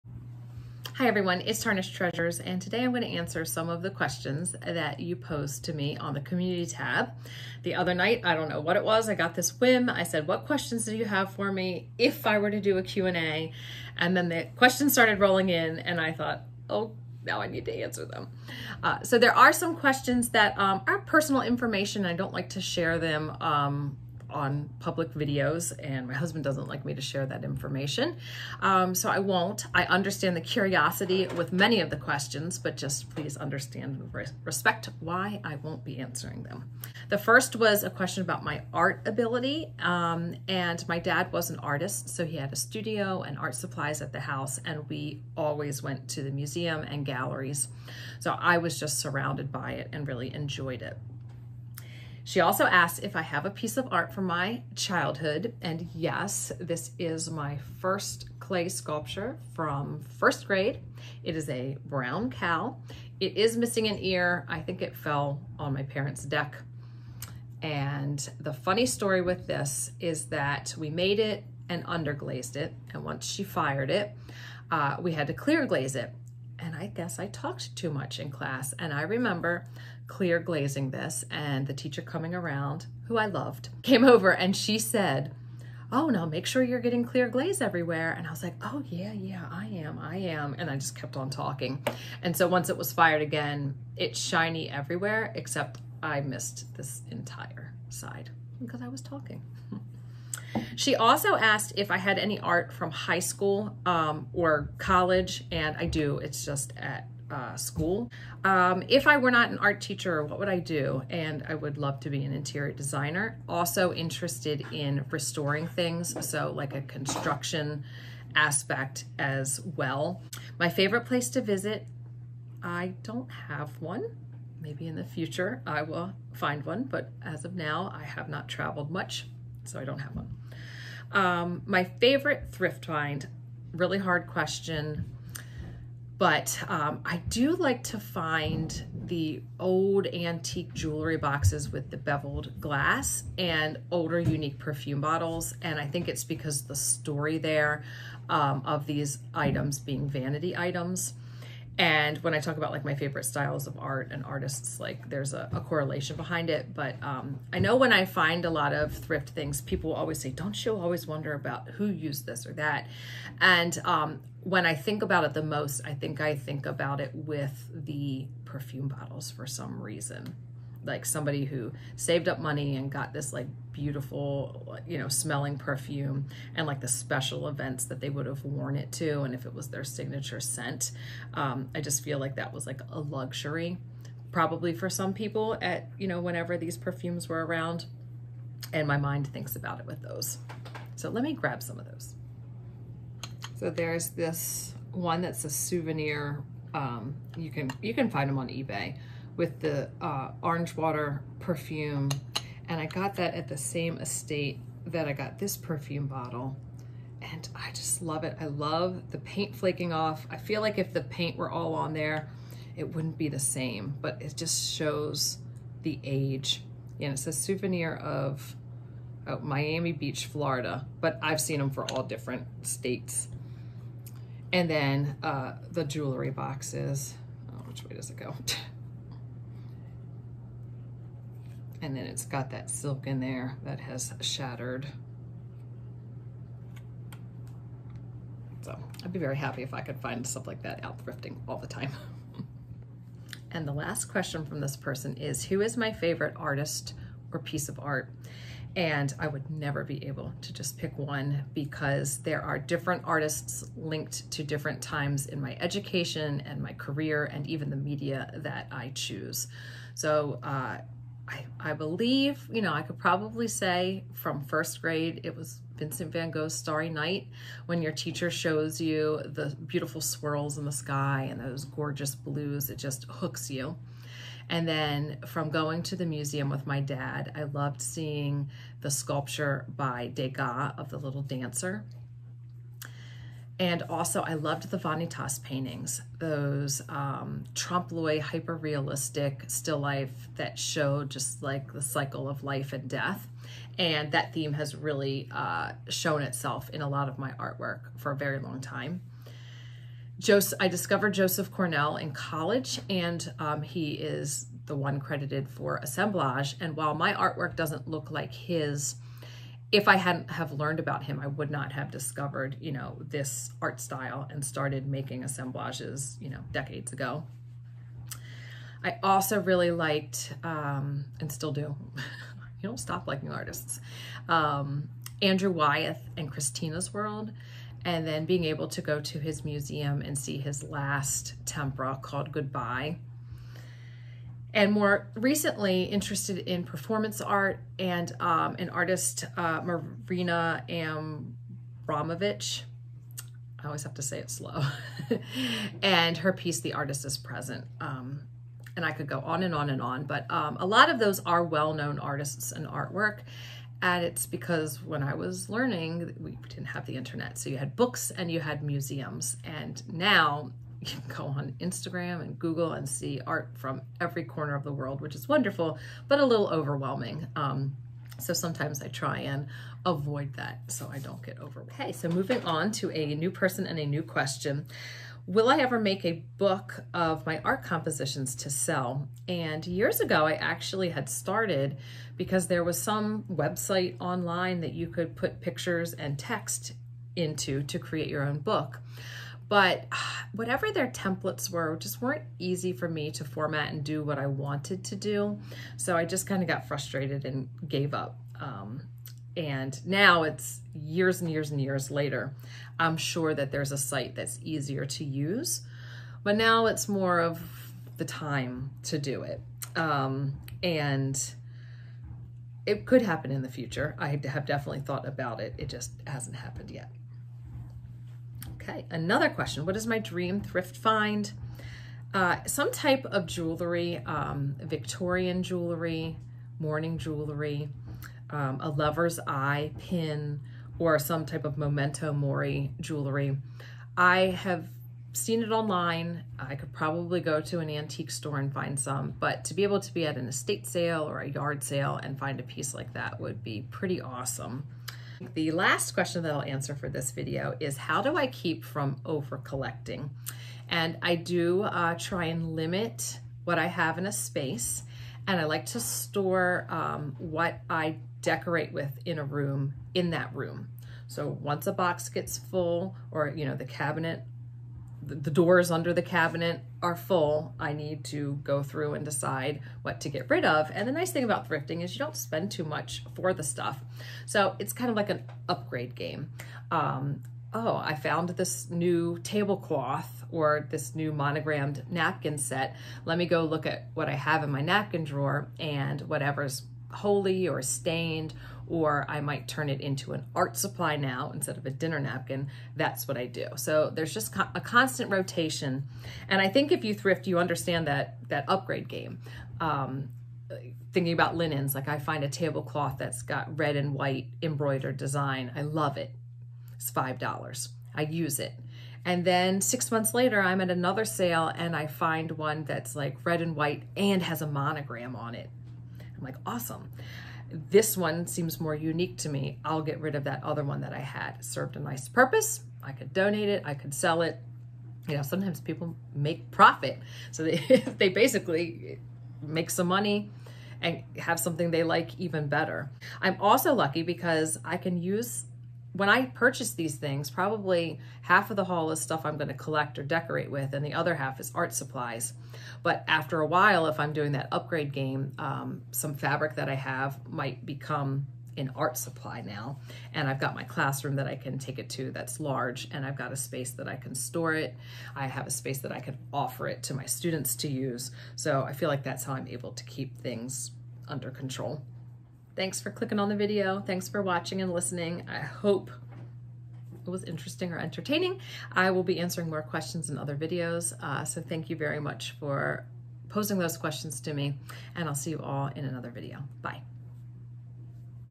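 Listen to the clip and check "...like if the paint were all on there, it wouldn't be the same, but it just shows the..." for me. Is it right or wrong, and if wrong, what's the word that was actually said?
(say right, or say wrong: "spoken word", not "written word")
right.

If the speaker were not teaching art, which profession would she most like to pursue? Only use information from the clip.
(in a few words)
Interior designer.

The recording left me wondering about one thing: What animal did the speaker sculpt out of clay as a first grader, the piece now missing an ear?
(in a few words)
Cow.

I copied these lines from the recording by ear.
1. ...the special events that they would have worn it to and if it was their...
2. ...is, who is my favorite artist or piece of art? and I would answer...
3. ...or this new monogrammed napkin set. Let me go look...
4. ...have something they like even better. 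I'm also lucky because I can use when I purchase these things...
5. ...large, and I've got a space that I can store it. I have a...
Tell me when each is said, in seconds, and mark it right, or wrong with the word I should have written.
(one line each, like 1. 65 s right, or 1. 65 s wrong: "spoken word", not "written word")
1. 176 s right
2. 245 s wrong: "never", not "answer"
3. 480 s right
4. 531 s right
5. 552 s right.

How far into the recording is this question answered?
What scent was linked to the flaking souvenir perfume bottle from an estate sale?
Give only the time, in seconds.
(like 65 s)
200 s.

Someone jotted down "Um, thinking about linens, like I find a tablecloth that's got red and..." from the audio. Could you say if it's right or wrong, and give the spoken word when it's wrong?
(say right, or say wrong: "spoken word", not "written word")
right.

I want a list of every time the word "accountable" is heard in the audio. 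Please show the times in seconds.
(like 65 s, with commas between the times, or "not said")
not said.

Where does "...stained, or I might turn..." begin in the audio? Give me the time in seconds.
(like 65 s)
487 s.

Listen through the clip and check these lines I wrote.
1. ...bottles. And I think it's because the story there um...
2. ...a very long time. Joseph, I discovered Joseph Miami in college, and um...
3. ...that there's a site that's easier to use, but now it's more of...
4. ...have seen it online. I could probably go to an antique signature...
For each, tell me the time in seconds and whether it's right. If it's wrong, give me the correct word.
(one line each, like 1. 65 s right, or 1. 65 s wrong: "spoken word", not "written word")
1. 145 s right
2. 298 s wrong: "Cornell", not "Miami"
3. 403 s right
4. 434 s wrong: "store", not "signature".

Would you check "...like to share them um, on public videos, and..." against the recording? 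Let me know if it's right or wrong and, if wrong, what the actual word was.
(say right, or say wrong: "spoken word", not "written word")
right.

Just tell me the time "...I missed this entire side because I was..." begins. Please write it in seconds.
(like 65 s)
96 s.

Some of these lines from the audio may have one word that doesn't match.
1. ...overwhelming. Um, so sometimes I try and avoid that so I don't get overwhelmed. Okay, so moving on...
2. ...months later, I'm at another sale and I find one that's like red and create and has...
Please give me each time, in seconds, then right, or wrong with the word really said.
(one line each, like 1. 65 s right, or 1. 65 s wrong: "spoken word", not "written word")
1. 366 s right
2. 509 s wrong: "white", not "create".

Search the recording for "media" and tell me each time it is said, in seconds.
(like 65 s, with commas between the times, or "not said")
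257 s.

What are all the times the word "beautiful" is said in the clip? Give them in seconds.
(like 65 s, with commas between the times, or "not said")
173 s, 269 s.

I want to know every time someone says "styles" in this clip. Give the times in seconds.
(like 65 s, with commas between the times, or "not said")
153 s, 313 s.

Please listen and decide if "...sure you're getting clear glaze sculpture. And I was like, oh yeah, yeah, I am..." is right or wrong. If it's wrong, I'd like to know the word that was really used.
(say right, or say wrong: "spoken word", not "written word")
wrong: "everywhere", not "sculpture".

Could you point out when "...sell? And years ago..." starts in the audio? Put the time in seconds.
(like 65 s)
378 s.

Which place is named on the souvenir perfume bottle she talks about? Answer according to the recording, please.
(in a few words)
Miami Beach, Florida.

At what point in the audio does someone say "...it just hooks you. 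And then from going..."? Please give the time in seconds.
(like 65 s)
272 s.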